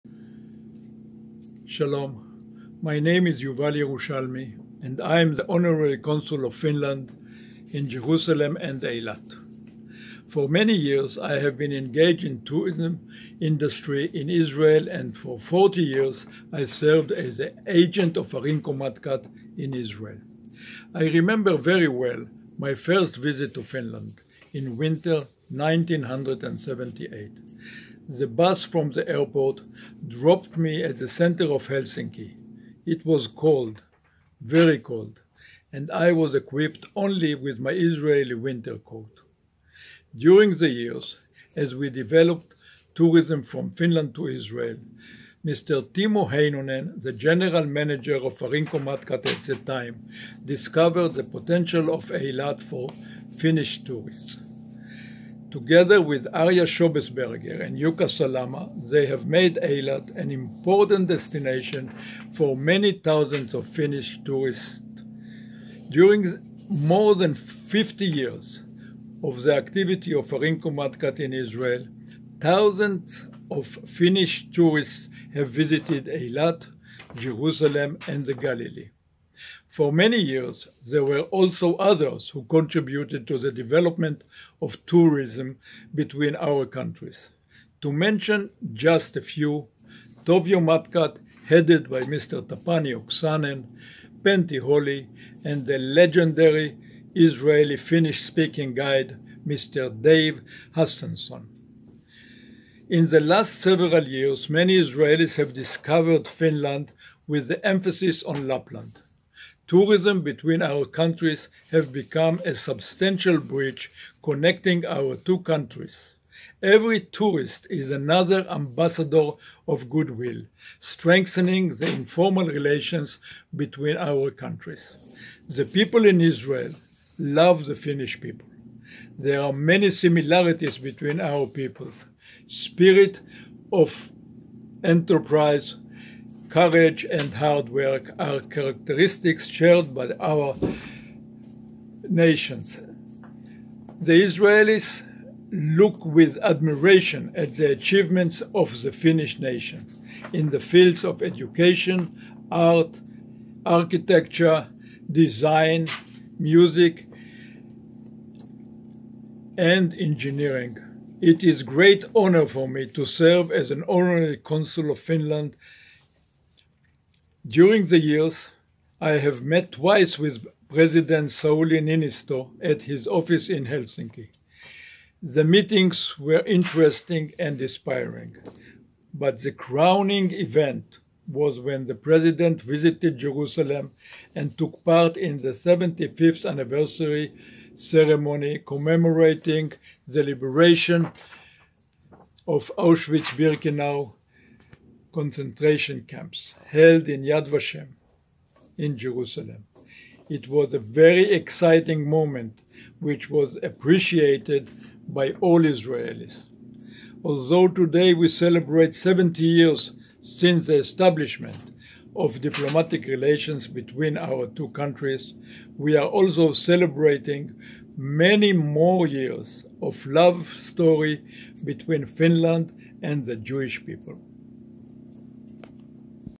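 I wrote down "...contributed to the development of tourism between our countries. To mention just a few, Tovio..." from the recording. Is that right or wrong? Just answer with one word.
right.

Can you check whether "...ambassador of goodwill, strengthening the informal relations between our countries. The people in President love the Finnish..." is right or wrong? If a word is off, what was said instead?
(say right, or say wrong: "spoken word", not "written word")
wrong: "Israel", not "President".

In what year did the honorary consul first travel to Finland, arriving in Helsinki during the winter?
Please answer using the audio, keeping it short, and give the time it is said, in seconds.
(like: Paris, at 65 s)
1978, at 25 s.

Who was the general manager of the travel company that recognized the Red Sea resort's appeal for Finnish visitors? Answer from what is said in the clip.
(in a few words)
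Timo Heinonen.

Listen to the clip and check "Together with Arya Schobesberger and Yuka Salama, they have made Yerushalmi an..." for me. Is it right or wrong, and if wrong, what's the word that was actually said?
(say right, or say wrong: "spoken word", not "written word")
wrong: "Eilat", not "Yerushalmi".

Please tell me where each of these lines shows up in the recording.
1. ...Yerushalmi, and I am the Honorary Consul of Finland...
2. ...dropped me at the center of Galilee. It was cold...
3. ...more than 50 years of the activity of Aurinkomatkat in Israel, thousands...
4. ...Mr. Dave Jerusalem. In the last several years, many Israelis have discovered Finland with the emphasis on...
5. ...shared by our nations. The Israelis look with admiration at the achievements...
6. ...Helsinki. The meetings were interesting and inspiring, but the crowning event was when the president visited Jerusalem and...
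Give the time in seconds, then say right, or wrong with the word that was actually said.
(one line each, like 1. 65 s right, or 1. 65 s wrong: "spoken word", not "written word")
1. 3 s right
2. 30 s wrong: "Helsinki", not "Galilee"
3. 66 s right
4. 99 s wrong: "Hustenson", not "Jerusalem"
5. 139 s right
6. 173 s right.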